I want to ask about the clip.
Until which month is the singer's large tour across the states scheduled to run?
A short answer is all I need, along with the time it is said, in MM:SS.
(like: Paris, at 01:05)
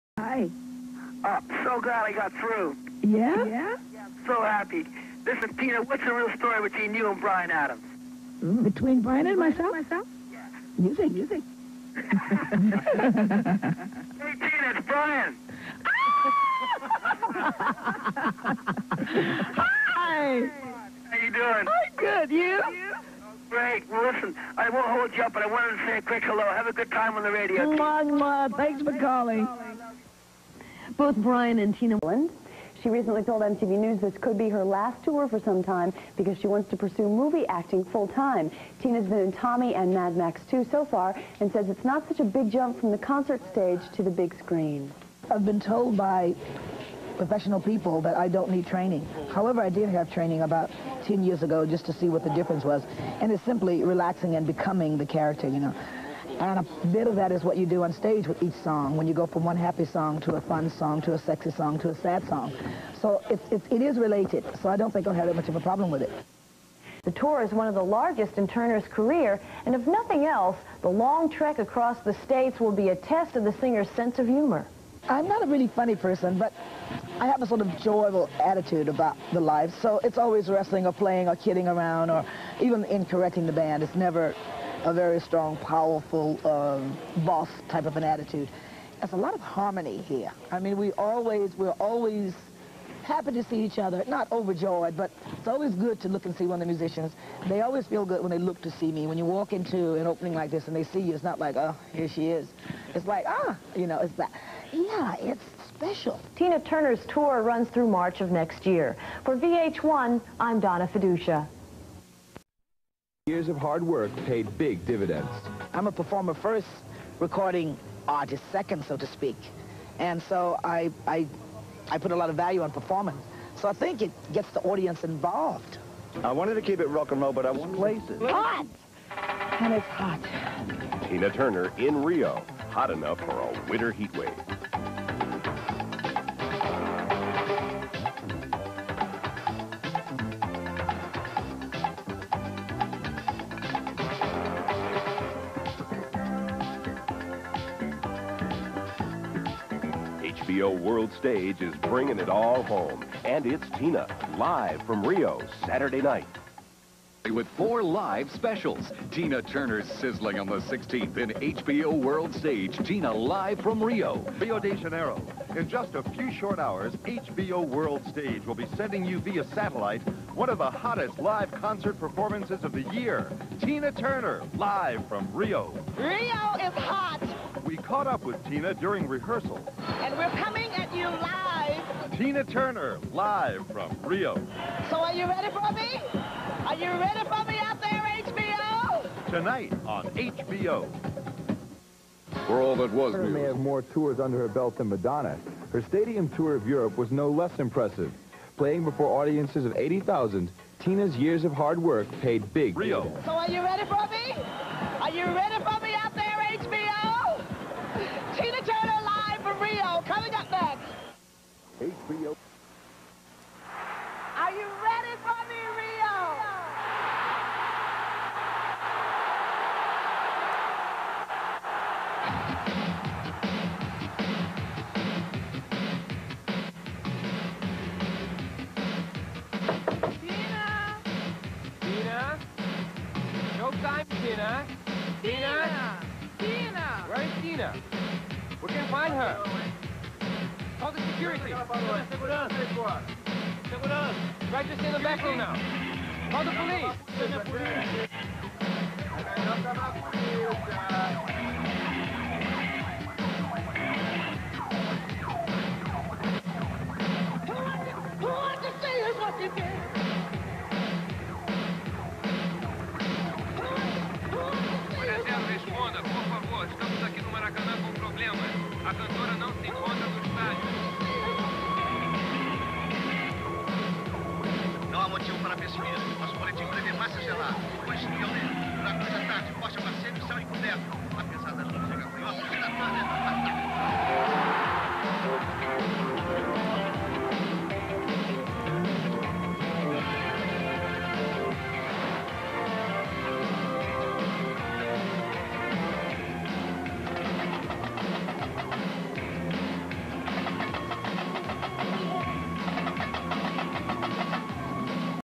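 March, at 01:47.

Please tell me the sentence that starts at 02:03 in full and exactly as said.
So I think it gets the audience involved.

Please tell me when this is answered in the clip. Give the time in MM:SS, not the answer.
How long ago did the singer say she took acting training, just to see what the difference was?
00:51.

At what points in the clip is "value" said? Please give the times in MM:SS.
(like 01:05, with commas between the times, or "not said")
02:02.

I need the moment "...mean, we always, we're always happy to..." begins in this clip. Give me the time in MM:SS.
01:30.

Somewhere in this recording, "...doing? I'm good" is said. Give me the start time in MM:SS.
00:21.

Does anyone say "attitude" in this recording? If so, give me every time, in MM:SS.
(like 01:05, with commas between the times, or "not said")
01:18, 01:28.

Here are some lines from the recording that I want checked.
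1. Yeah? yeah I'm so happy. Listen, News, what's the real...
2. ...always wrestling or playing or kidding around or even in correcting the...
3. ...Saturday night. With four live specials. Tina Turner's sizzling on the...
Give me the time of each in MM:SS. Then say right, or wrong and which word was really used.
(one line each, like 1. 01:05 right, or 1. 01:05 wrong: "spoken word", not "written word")
1. 00:03 wrong: "Tina", not "News"
2. 01:20 right
3. 02:35 right.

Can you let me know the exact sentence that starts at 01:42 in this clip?
It's like, ah, you know, it's that.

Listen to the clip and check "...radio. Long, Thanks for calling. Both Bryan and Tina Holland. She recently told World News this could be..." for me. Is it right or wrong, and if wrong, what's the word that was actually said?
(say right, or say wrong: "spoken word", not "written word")
wrong: "MTV", not "World".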